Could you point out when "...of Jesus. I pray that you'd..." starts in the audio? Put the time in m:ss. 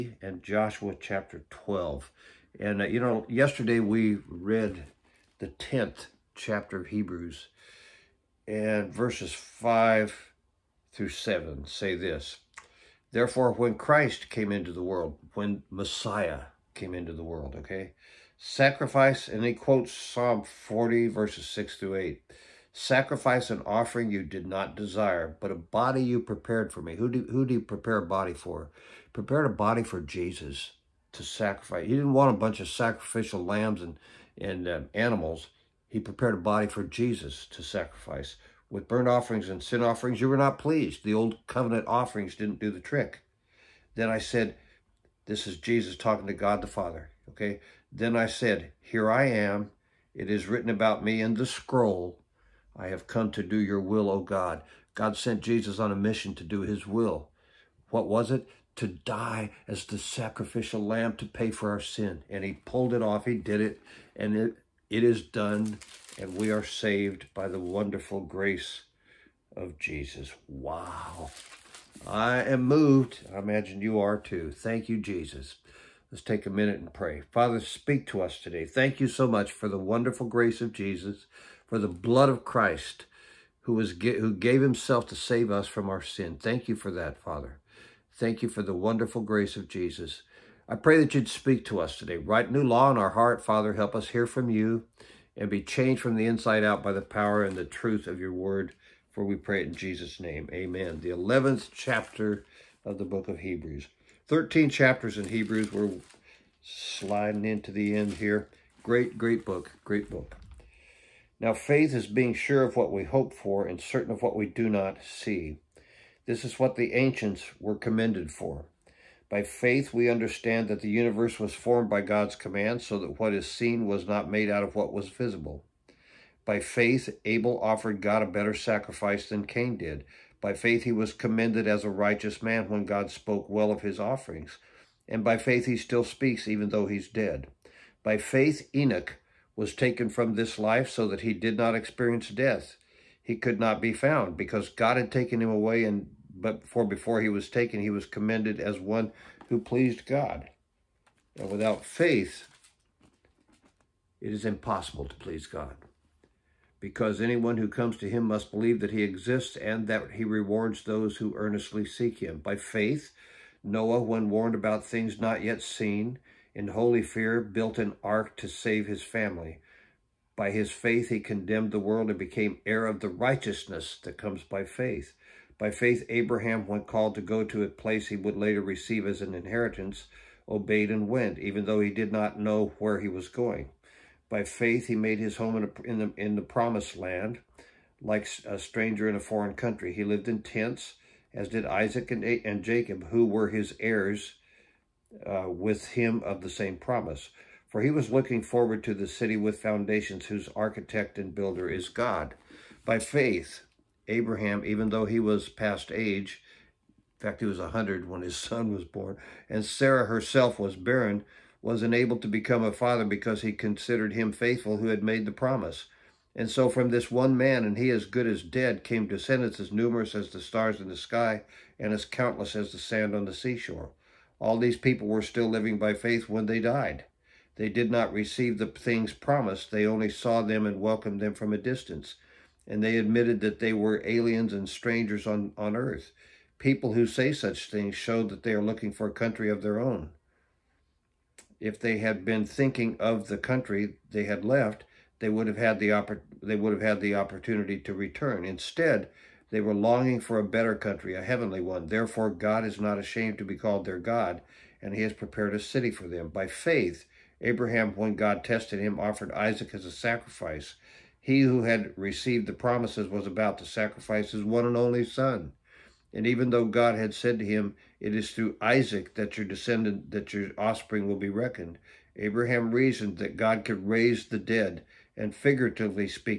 1:29.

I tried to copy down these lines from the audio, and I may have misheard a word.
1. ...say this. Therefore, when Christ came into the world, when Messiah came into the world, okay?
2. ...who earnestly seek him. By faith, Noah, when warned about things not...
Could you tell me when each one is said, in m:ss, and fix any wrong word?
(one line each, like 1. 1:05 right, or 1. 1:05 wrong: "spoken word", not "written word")
1. 0:11 right
2. 2:41 right.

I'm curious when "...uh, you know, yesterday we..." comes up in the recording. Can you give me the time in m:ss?
0:02.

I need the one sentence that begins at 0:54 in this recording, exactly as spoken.
God sent Jesus on a mission to do his will.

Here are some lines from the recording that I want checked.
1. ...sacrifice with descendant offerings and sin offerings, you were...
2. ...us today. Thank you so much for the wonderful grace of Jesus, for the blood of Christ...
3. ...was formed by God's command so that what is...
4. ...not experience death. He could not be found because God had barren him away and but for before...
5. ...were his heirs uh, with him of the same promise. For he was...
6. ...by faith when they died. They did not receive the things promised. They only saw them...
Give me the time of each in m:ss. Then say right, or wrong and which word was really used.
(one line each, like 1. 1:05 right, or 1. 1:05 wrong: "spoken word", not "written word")
1. 0:37 wrong: "burnt", not "descendant"
2. 1:18 right
3. 2:01 right
4. 2:21 wrong: "taken", not "barren"
5. 3:13 right
6. 3:45 right.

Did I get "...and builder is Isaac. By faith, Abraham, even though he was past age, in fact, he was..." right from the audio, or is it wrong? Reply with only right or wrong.
wrong.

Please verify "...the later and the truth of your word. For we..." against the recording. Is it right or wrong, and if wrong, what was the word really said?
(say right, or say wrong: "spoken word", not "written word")
wrong: "power", not "later".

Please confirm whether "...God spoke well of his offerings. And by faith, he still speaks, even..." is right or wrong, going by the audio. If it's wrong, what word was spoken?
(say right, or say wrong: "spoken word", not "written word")
right.